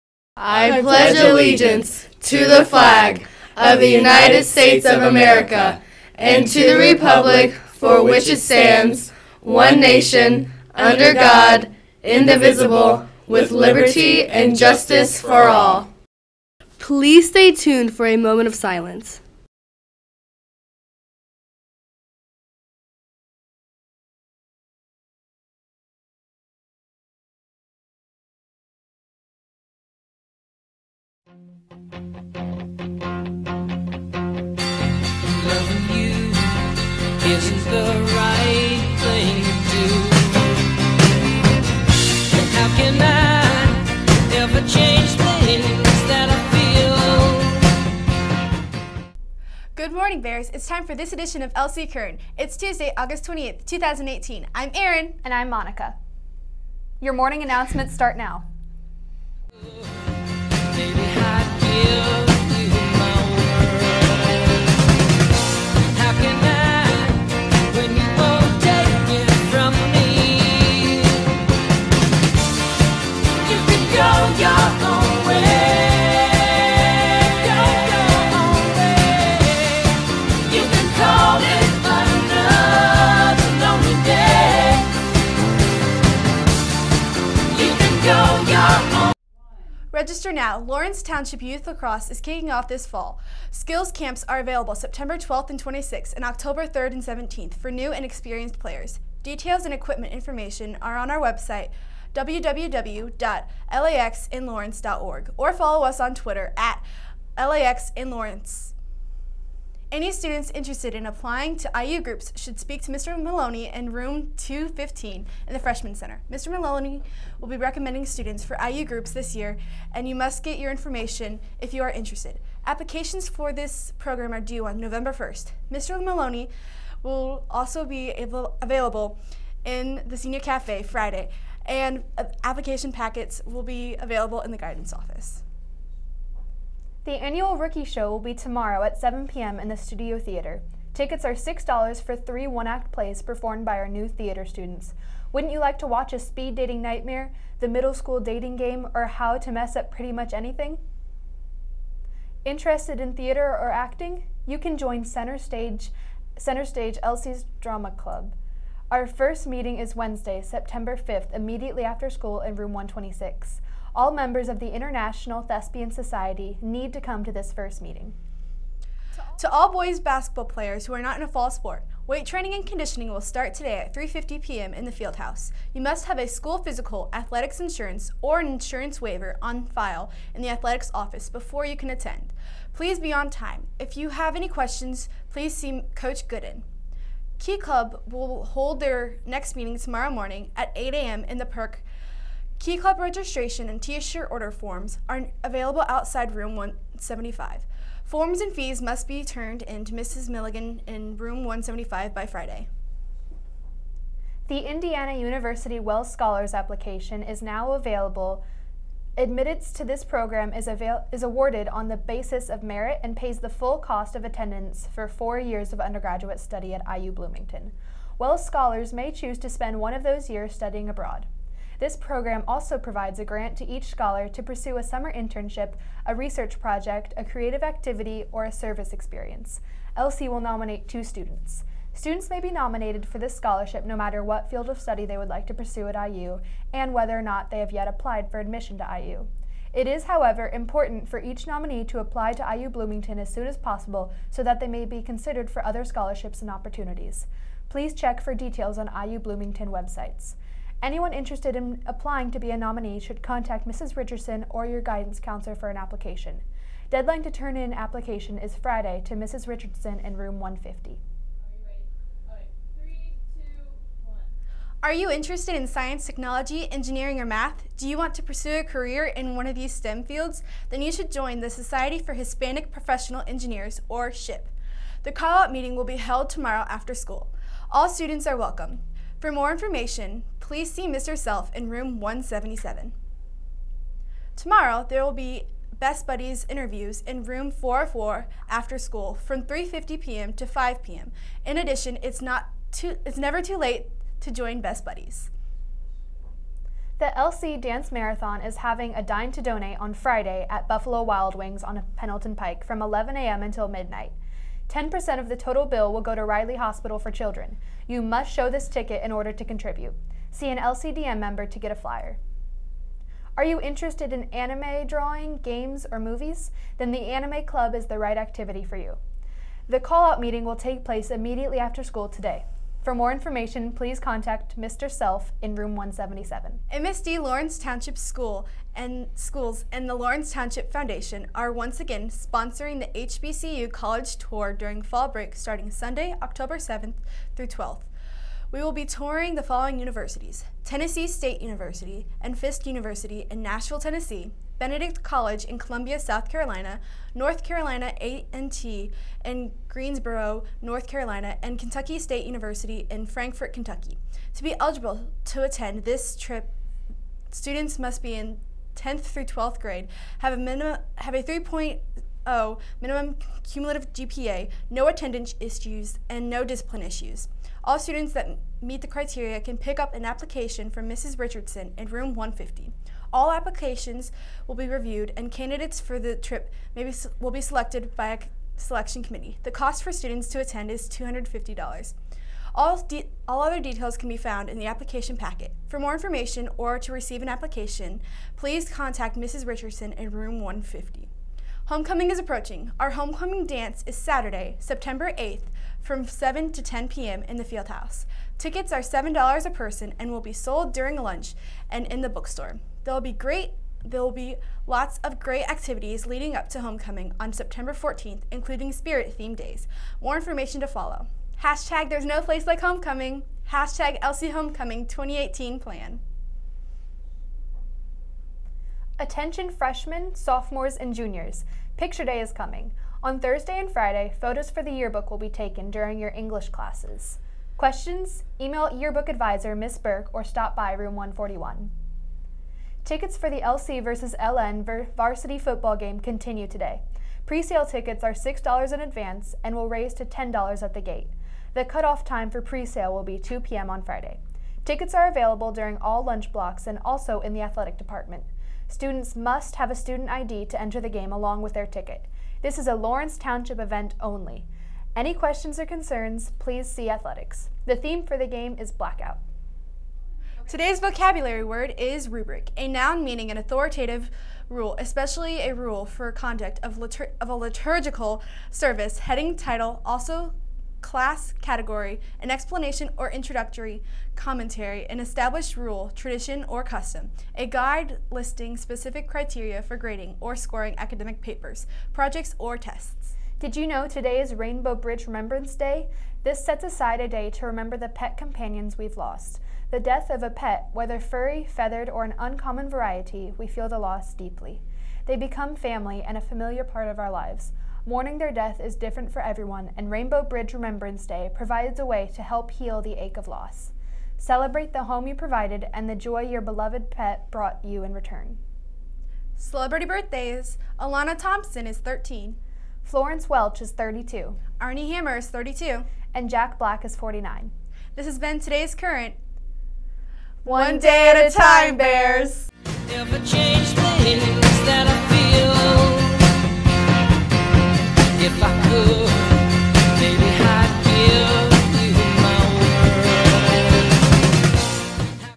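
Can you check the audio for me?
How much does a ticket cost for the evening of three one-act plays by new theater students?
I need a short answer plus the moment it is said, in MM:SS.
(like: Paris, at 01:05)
$6, at 02:20.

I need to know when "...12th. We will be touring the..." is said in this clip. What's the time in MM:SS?
05:37.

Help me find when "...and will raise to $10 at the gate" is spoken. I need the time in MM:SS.
07:19.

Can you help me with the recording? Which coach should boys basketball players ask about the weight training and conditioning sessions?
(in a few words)
Coach Gooden.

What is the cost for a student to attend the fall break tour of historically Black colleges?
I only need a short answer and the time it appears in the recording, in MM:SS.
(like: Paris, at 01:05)
$250, at 06:19.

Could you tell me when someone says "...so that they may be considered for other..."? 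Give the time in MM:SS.
04:04.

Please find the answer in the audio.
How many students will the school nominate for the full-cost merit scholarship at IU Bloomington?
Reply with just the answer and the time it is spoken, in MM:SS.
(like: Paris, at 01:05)
2, at 03:49.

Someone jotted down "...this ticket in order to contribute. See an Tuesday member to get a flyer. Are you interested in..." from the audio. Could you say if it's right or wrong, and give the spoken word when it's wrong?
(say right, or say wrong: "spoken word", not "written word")
wrong: "LCDM", not "Tuesday".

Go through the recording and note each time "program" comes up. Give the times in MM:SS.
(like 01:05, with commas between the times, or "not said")
02:03, 03:30, 03:41.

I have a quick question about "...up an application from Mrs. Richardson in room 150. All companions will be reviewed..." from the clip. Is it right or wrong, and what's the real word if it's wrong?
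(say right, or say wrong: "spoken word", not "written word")
wrong: "applications", not "companions".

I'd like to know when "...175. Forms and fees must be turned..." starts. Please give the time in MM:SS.
03:16.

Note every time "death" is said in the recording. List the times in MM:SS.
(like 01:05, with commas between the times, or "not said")
08:09, 08:18.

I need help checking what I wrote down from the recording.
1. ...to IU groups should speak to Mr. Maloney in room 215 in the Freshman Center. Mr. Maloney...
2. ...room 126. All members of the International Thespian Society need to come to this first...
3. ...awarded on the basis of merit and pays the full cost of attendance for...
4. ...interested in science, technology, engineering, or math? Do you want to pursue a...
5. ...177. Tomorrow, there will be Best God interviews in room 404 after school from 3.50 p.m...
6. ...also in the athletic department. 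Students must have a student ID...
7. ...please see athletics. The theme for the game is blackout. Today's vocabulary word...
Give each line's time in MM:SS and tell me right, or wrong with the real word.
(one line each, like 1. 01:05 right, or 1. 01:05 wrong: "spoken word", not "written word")
1. 01:51 right
2. 02:42 right
3. 03:31 right
4. 04:25 right
5. 04:41 wrong: "Buddies", not "God"
6. 07:26 right
7. 07:36 right.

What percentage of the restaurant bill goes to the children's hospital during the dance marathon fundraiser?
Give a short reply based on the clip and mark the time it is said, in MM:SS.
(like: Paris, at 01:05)
10%, at 05:04.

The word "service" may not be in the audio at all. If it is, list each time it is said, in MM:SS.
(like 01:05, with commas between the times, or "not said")
03:48, 07:48.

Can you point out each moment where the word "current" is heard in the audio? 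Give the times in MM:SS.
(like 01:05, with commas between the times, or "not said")
00:51, 08:38.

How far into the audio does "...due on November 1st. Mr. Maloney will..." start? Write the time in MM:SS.
02:04.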